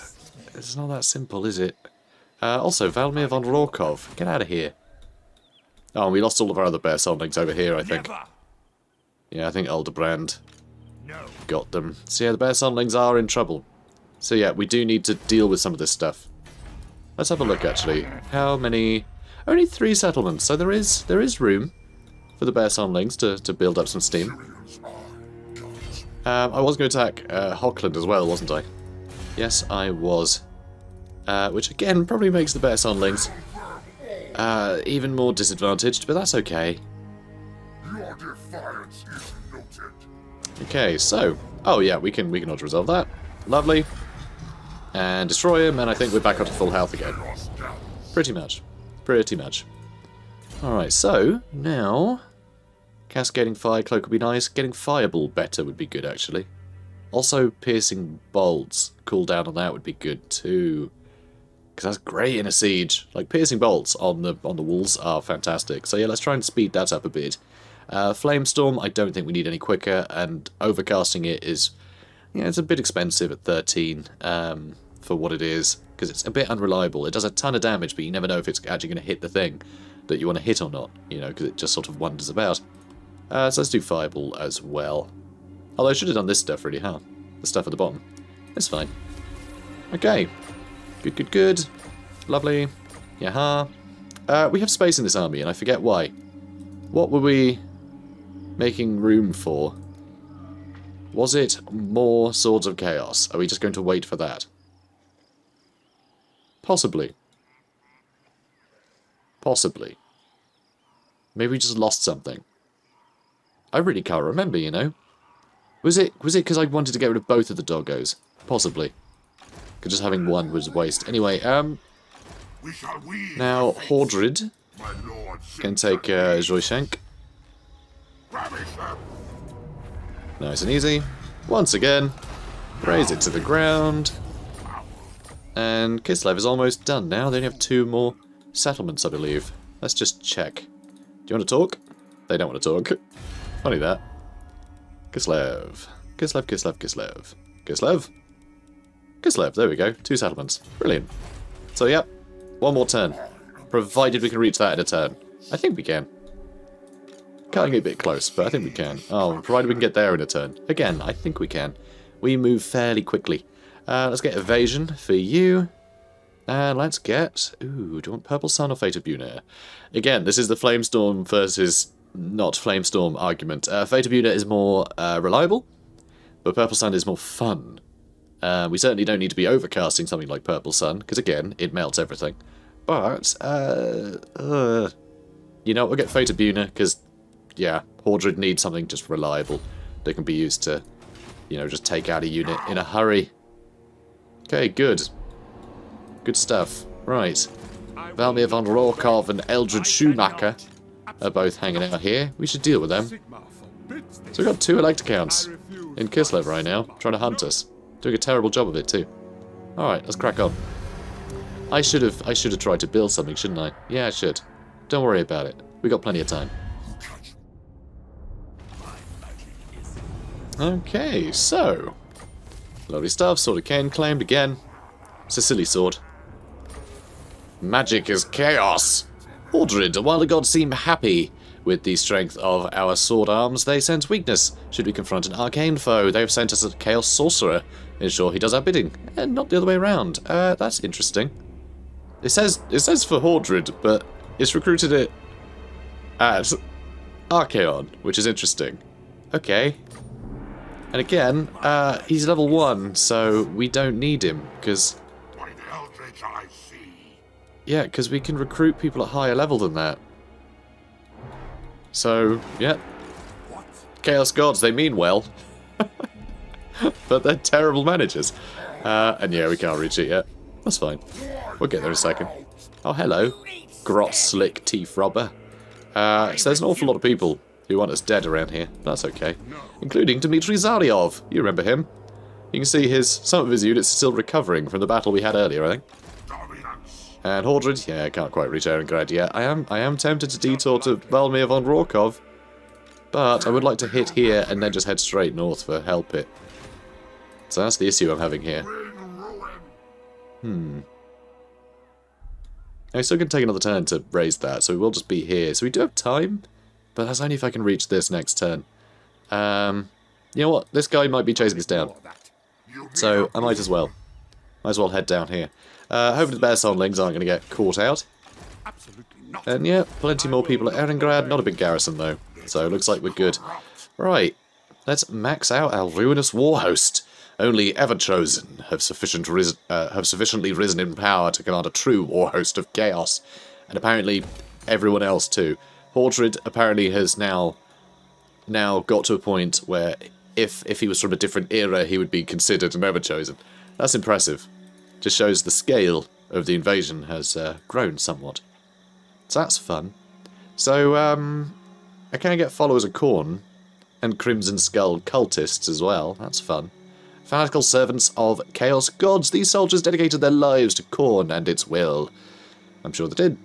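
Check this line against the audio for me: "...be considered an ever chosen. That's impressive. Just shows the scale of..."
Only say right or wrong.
right.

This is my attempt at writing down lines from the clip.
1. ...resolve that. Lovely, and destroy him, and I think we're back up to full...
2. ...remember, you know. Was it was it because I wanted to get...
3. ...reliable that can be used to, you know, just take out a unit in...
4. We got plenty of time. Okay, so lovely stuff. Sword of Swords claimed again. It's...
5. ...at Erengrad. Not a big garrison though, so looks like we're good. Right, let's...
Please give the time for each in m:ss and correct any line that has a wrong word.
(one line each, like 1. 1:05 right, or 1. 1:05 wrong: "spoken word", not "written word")
1. 0:42 right
2. 1:54 right
3. 3:09 right
4. 3:35 wrong: "Cain", not "Swords"
5. 5:20 right.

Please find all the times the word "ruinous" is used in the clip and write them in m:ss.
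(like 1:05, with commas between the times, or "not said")
5:25.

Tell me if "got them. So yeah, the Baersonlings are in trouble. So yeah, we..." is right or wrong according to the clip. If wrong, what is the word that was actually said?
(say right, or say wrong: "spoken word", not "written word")
right.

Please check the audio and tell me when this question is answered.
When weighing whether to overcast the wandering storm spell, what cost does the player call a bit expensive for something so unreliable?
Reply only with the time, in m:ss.
1:13.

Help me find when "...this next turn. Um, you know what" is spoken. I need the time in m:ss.
5:07.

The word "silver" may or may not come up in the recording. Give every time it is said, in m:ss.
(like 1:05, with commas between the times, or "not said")
not said.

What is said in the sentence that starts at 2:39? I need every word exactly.
Oh, provided we can get there in a turn.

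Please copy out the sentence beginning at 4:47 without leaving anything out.
And Hordred, yeah, I can't quite reach Erengrad yet.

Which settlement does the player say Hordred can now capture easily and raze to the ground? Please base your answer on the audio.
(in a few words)
Joyshank.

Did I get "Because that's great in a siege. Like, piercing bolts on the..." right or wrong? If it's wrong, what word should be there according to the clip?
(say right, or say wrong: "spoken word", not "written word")
right.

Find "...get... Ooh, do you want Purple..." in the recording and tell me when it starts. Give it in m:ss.
2:46.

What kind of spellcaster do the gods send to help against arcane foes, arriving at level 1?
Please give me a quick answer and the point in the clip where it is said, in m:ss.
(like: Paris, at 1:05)
Chaos Sorcerer, at 3:56.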